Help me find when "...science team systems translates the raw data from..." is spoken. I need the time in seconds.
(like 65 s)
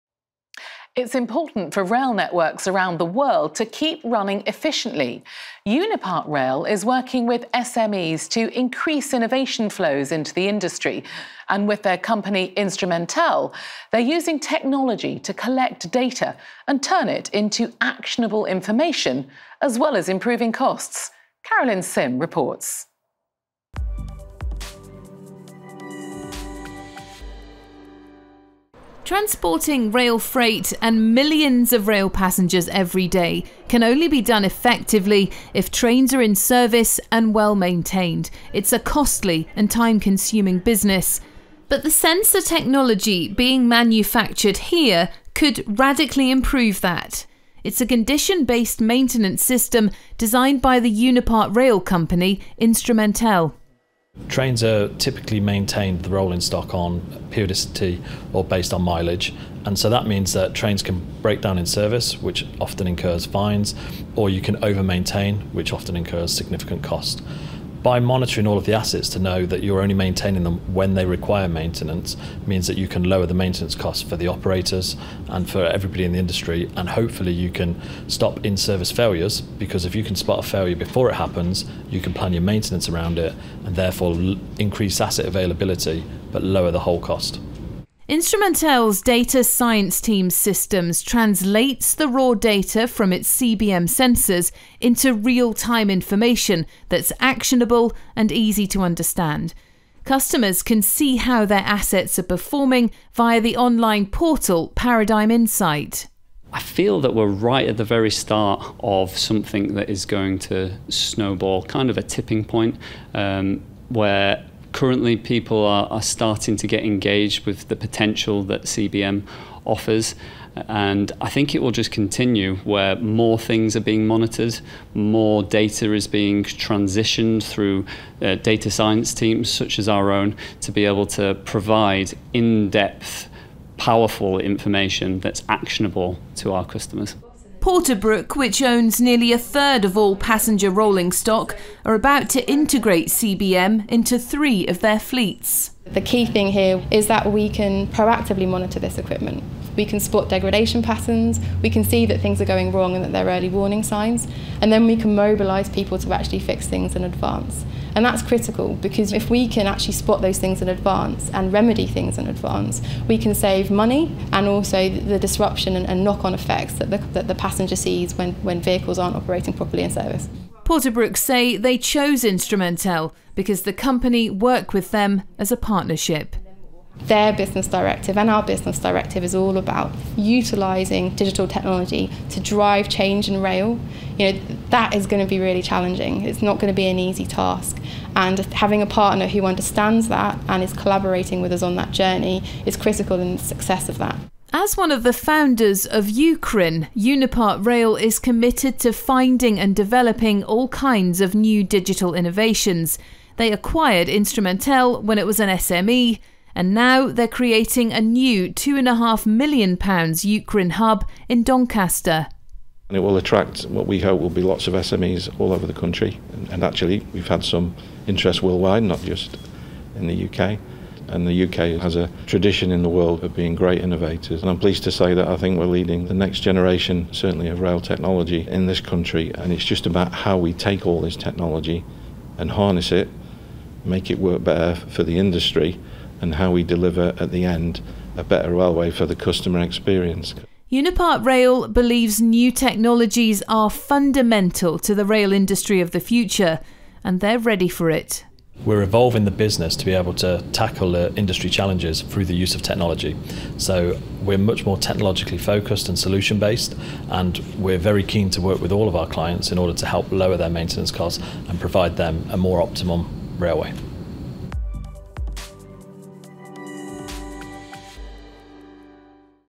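89 s.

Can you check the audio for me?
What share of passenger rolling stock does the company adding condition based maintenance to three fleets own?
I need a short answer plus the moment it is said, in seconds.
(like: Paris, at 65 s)
nearly a third, at 138 s.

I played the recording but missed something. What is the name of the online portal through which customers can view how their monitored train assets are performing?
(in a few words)
Paradigm Insight.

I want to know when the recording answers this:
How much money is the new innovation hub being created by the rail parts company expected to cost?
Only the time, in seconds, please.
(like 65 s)
208 s.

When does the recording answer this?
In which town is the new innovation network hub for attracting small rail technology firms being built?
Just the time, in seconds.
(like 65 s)
211 s.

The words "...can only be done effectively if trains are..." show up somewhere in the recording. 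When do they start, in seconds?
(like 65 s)
33 s.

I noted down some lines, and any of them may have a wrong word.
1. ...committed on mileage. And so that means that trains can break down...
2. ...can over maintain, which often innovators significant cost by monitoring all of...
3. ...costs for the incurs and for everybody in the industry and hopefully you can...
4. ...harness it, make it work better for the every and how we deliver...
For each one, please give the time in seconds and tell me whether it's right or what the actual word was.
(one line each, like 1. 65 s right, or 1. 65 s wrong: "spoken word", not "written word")
1. 58 s wrong: "based", not "committed"
2. 64 s wrong: "incurs", not "innovators"
3. 73 s wrong: "operators", not "incurs"
4. 232 s wrong: "industry", not "every".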